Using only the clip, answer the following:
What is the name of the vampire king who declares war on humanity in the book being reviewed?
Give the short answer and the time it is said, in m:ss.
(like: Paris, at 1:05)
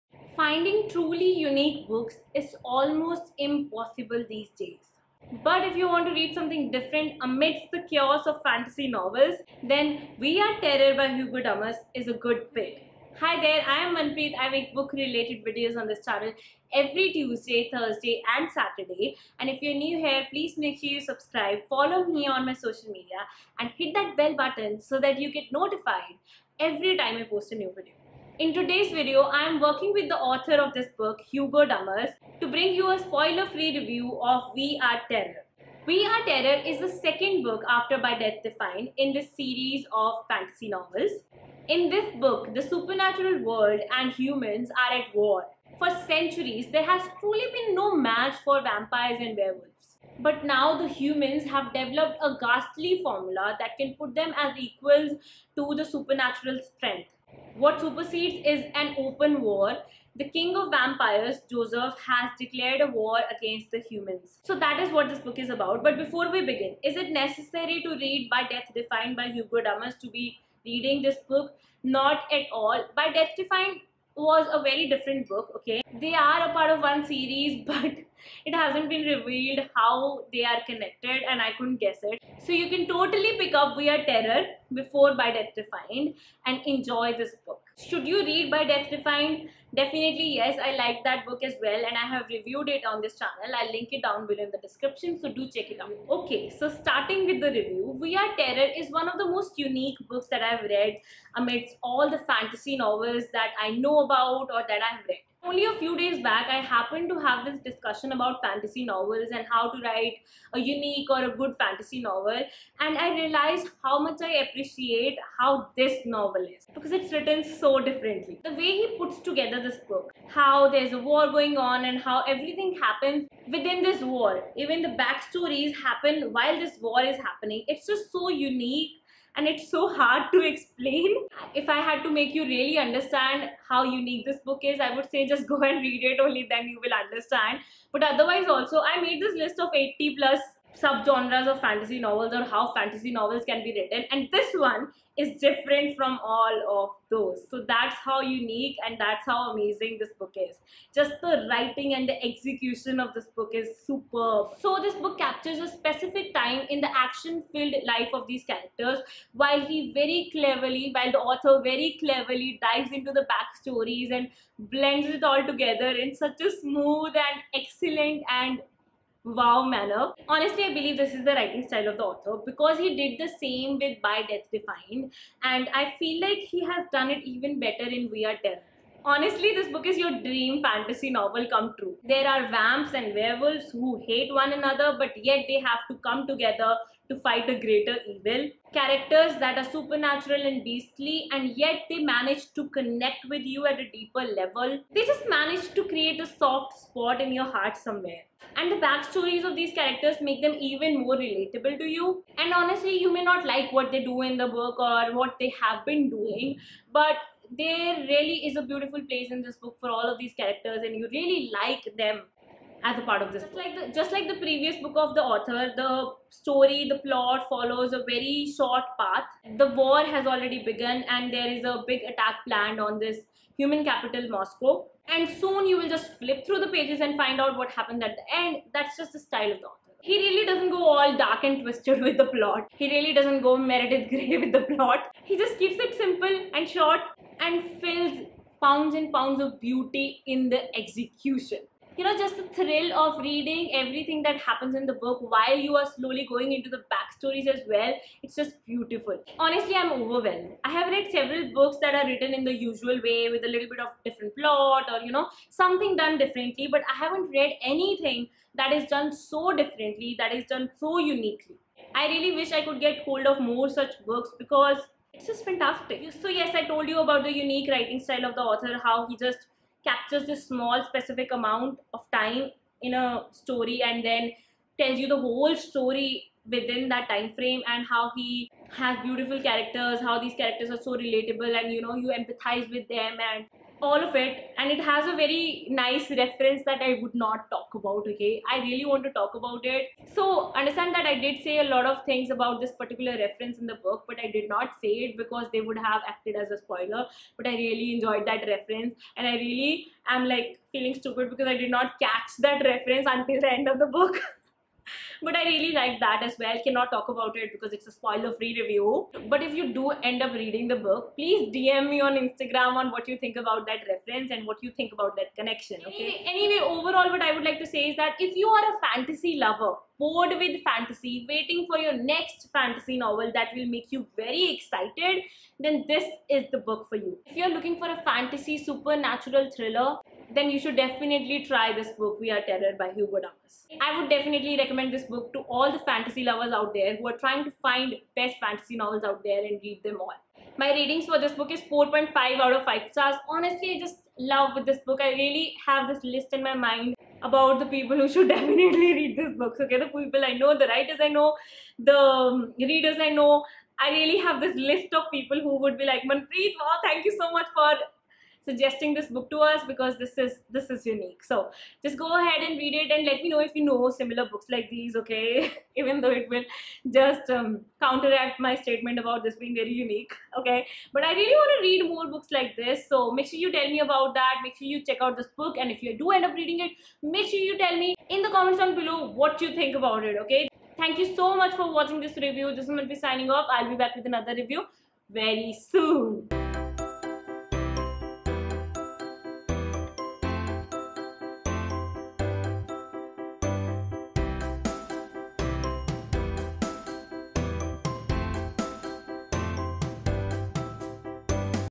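Joseph, at 1:01.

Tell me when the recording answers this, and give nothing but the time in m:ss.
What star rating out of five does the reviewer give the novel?
5:41.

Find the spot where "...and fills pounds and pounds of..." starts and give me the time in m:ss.
3:57.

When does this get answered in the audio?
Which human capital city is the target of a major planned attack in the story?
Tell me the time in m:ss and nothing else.
3:44.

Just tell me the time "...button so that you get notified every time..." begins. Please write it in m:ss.
0:24.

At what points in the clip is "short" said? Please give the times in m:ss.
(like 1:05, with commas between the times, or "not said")
3:38, 3:56.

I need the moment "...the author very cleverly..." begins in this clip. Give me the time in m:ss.
2:41.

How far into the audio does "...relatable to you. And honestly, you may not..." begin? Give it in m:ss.
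3:21.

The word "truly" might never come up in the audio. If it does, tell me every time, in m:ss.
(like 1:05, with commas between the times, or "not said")
0:00, 0:47.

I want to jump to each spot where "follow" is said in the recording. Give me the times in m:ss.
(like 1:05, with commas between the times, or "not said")
0:21, 3:37.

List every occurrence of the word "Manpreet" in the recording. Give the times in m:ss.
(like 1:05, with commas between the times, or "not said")
0:13, 5:56.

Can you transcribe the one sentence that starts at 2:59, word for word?
Honestly, this book is your dream fantasy novel come true.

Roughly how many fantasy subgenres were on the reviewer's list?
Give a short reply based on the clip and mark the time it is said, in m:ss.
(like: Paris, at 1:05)
80 plus, at 2:19.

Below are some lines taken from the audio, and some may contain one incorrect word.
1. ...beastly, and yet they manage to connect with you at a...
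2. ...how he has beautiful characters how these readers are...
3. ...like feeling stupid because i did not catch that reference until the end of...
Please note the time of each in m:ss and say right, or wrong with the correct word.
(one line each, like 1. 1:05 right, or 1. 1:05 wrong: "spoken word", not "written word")
1. 3:10 right
2. 4:37 wrong: "characters", not "readers"
3. 5:00 right.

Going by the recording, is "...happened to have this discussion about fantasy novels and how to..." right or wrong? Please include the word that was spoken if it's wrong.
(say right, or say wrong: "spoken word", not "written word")
right.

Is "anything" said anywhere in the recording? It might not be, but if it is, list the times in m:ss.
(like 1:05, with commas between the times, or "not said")
4:17.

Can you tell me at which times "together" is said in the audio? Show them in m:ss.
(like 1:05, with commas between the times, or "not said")
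1:59, 2:45, 3:06.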